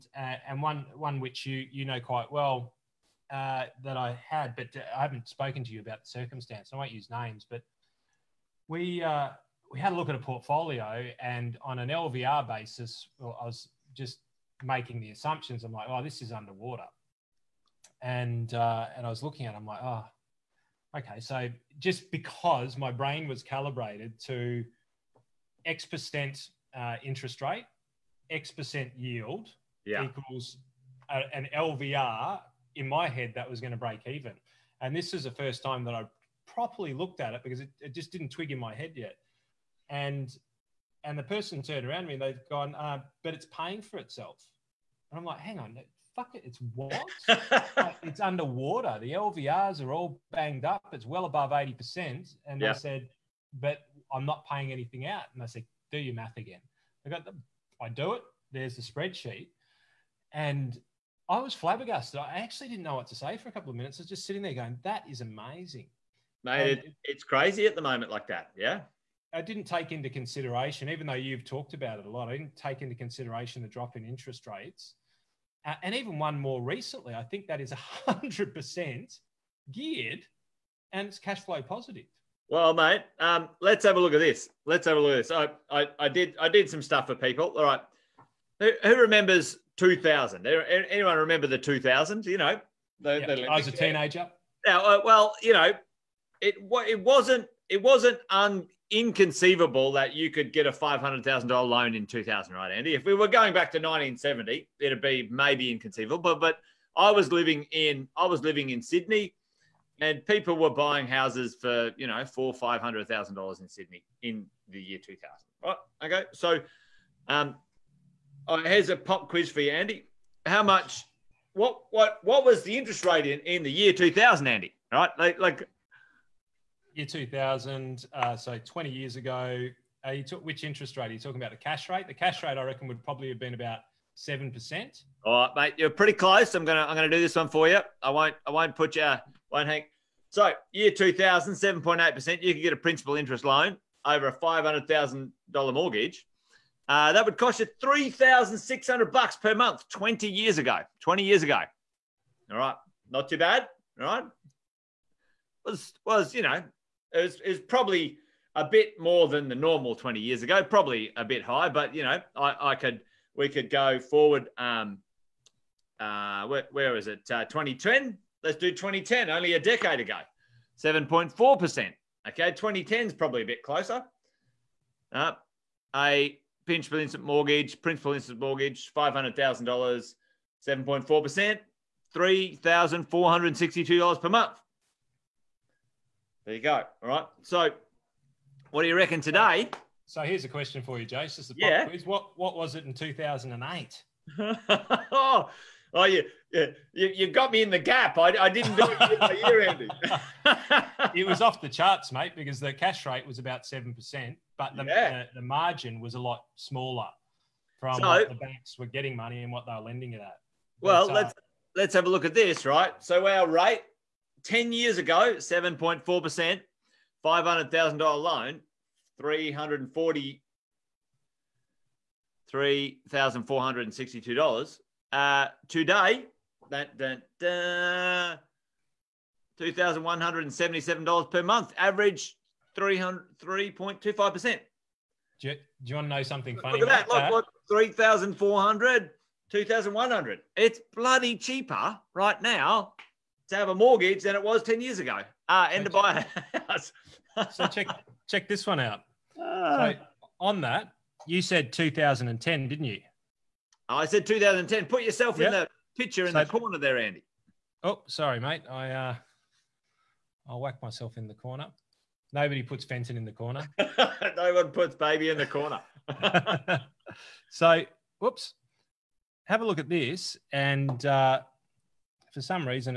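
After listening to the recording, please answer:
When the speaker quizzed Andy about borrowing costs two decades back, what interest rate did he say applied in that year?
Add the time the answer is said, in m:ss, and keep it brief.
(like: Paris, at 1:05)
7.8%, at 2:21.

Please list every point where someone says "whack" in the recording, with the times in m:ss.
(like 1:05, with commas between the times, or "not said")
4:20.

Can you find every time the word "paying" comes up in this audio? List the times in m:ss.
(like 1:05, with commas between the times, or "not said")
0:43, 0:54.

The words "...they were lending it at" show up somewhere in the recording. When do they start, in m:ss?
3:29.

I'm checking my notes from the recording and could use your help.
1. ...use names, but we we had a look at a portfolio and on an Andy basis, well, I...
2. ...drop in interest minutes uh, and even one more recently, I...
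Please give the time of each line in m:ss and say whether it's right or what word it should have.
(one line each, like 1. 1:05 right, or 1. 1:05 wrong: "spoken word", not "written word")
1. 0:06 wrong: "LVR", not "Andy"
2. 1:13 wrong: "rates", not "minutes".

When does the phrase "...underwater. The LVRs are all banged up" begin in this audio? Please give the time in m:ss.
0:48.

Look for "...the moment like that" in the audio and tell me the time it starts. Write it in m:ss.
1:07.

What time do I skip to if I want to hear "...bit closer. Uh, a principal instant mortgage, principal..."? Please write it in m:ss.
2:53.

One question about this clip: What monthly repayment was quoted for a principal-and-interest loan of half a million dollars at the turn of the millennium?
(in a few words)
$3,600.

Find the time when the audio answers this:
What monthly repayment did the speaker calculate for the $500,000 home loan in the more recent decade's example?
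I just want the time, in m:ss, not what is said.
3:02.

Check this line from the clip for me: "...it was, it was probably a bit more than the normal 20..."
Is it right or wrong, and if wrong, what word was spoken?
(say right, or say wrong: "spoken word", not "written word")
right.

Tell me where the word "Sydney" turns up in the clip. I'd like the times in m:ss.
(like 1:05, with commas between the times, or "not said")
1:48, 1:53.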